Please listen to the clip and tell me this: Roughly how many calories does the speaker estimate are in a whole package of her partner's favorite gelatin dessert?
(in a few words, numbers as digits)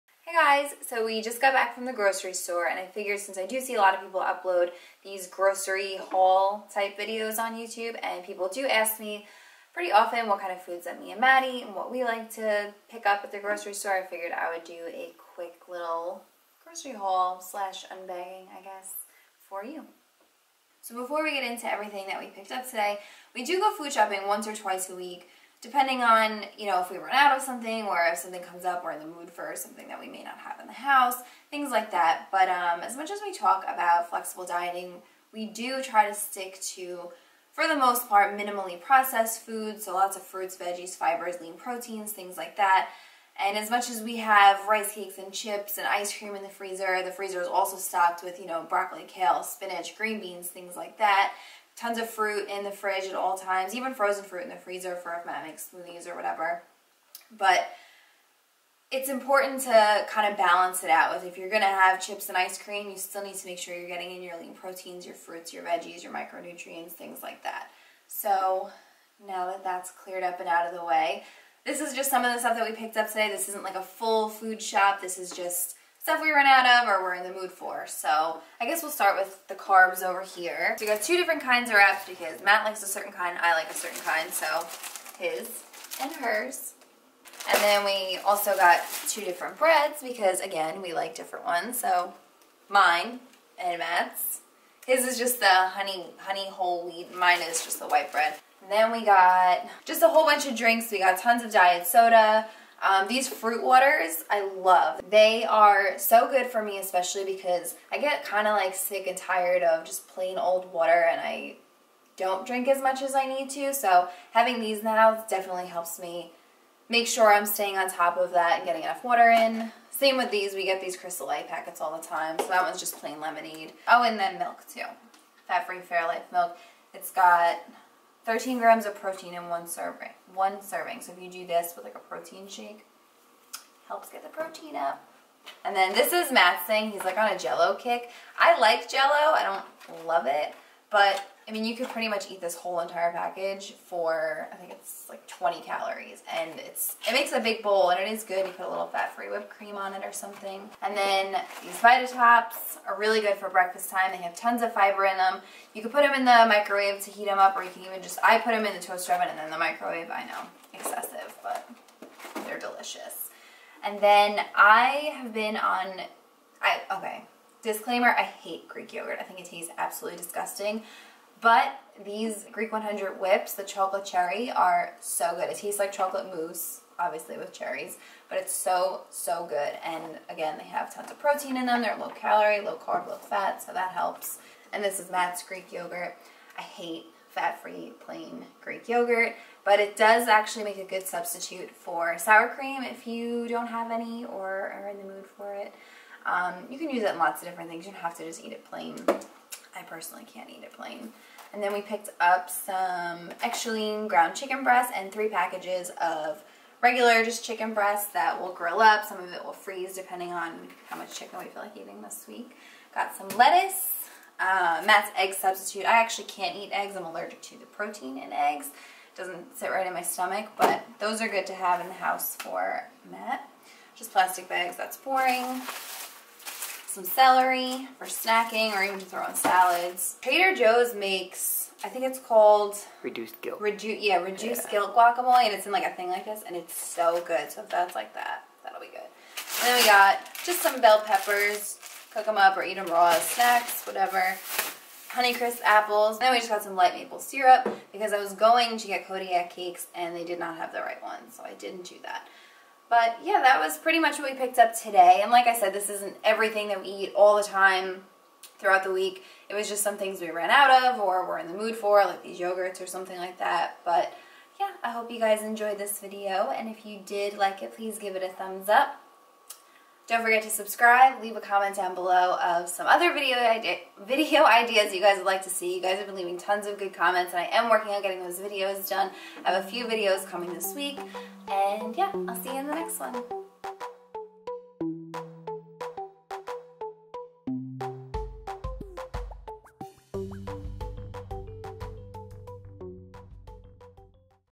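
20.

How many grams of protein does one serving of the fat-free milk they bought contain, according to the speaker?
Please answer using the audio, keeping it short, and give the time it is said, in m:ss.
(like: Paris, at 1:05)
13, at 2:08.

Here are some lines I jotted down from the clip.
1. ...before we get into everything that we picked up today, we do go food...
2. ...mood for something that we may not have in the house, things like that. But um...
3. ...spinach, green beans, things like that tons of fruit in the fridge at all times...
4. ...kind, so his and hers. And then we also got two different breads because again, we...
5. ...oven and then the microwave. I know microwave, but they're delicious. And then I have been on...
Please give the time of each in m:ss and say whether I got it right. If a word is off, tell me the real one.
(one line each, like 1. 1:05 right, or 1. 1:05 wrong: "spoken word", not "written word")
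1. 0:20 right
2. 0:29 right
3. 0:49 right
4. 1:24 right
5. 2:39 wrong: "excessive", not "microwave".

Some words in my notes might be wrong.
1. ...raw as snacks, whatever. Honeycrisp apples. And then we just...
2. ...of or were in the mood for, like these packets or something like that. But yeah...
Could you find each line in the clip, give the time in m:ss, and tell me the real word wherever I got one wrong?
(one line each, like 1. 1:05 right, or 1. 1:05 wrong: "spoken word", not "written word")
1. 4:02 right
2. 4:20 wrong: "yogurts", not "packets".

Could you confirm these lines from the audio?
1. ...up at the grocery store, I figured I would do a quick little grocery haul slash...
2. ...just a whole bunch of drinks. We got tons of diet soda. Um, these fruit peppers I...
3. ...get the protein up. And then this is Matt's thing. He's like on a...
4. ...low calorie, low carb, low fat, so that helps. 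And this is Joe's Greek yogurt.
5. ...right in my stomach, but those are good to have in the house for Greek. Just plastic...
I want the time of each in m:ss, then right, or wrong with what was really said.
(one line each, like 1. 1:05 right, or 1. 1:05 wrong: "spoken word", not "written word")
1. 0:13 right
2. 1:39 wrong: "waters", not "peppers"
3. 2:14 right
4. 3:01 wrong: "Matt", not "Joe"
5. 3:39 wrong: "Matt", not "Greek".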